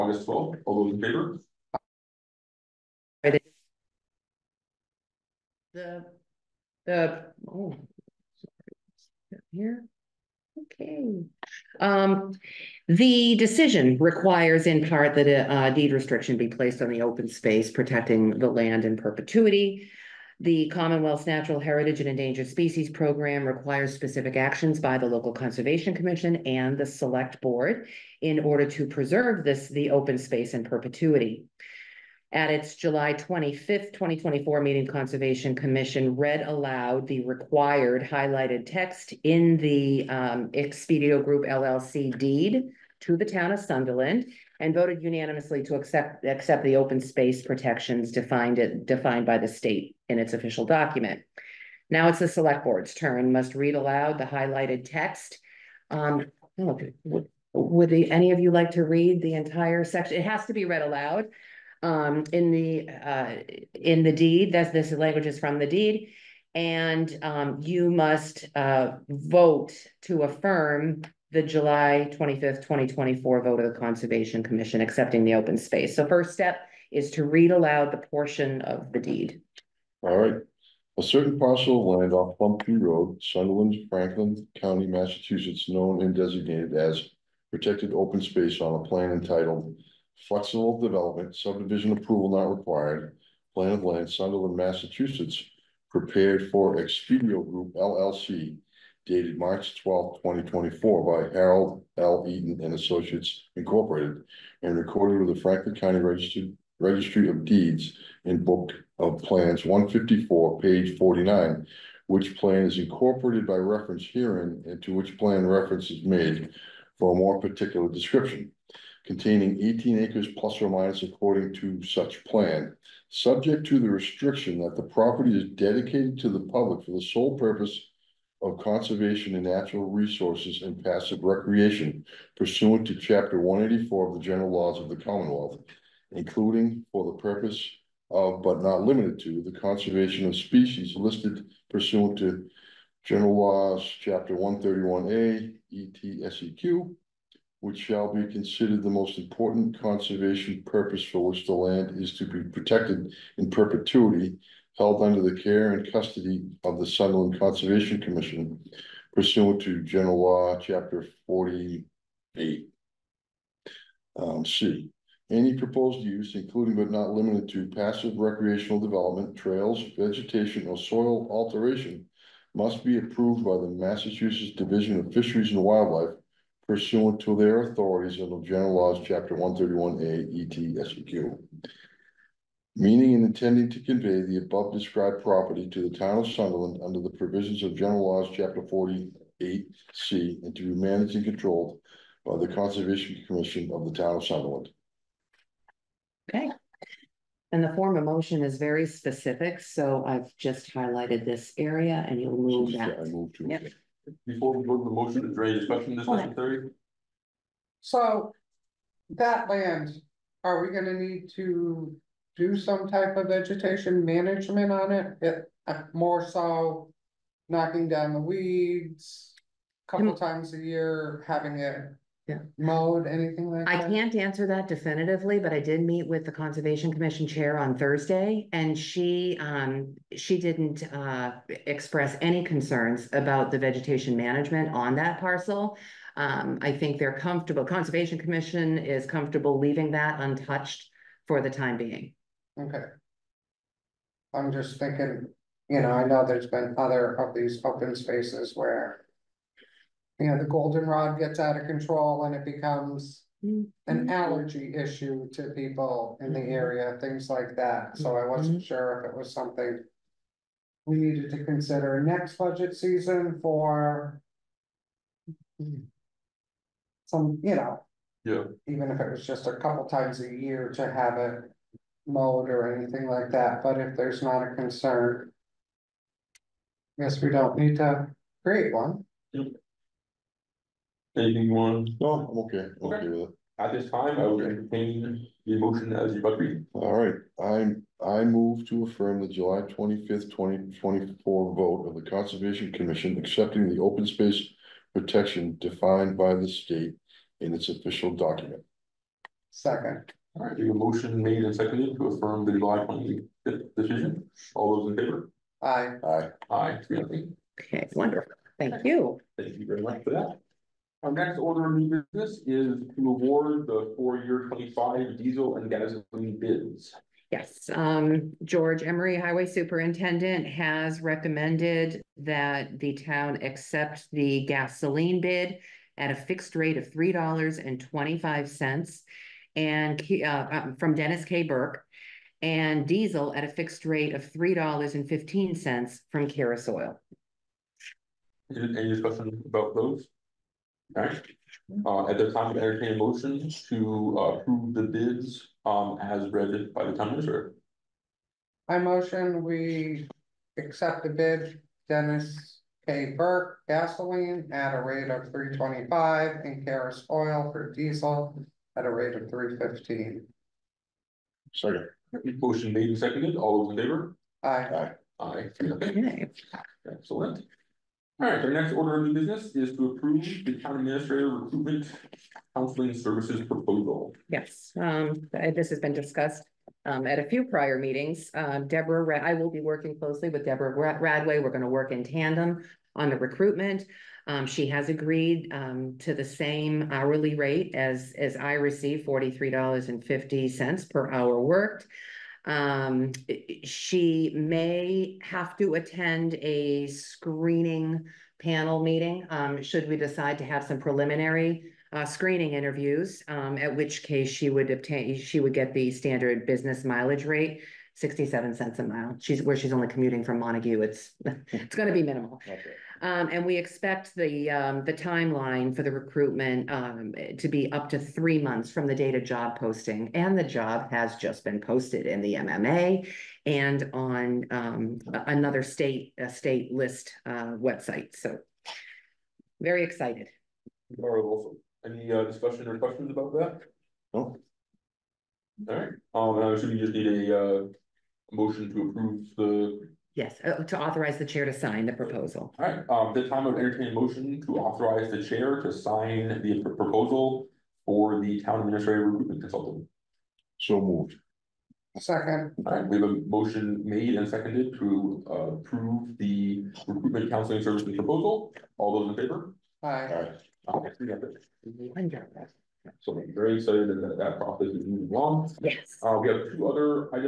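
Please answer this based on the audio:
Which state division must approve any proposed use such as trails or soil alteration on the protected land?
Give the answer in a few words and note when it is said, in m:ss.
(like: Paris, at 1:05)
Massachusetts Division of Fisheries and Wildlife, at 2:53.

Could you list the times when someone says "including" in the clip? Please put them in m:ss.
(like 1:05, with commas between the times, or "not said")
2:16, 2:46.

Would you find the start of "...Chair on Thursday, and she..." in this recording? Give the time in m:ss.
3:47.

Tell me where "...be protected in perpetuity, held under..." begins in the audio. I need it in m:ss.
2:32.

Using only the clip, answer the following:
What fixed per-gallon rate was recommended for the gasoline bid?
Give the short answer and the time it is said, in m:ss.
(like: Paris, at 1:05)
$3.25, at 5:26.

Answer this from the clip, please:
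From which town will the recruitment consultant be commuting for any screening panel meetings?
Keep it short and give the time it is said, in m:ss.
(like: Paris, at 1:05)
Montague, at 6:50.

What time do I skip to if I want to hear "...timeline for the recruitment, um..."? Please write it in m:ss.
6:54.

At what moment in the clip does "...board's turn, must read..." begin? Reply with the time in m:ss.
0:52.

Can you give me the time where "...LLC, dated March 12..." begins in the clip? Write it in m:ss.
1:37.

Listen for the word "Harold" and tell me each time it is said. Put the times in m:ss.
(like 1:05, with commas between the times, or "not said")
1:41.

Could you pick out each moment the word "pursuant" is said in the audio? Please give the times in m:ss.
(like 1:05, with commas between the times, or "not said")
2:12, 2:21, 2:39, 2:56.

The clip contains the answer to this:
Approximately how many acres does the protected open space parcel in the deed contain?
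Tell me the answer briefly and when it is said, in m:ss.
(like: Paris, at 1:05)
18 acres, at 1:59.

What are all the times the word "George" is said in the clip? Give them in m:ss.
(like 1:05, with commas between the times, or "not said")
5:18.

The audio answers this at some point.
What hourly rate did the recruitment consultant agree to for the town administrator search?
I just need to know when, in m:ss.
6:29.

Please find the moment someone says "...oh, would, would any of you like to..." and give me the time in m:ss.
0:56.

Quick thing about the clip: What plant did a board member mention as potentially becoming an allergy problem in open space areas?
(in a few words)
goldenrod.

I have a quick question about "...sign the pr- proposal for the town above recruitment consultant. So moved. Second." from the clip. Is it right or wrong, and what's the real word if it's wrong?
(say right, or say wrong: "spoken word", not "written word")
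wrong: "administrative", not "above".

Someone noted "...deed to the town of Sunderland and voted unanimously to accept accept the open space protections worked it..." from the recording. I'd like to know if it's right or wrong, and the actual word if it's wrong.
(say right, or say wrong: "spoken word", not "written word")
wrong: "defined", not "worked".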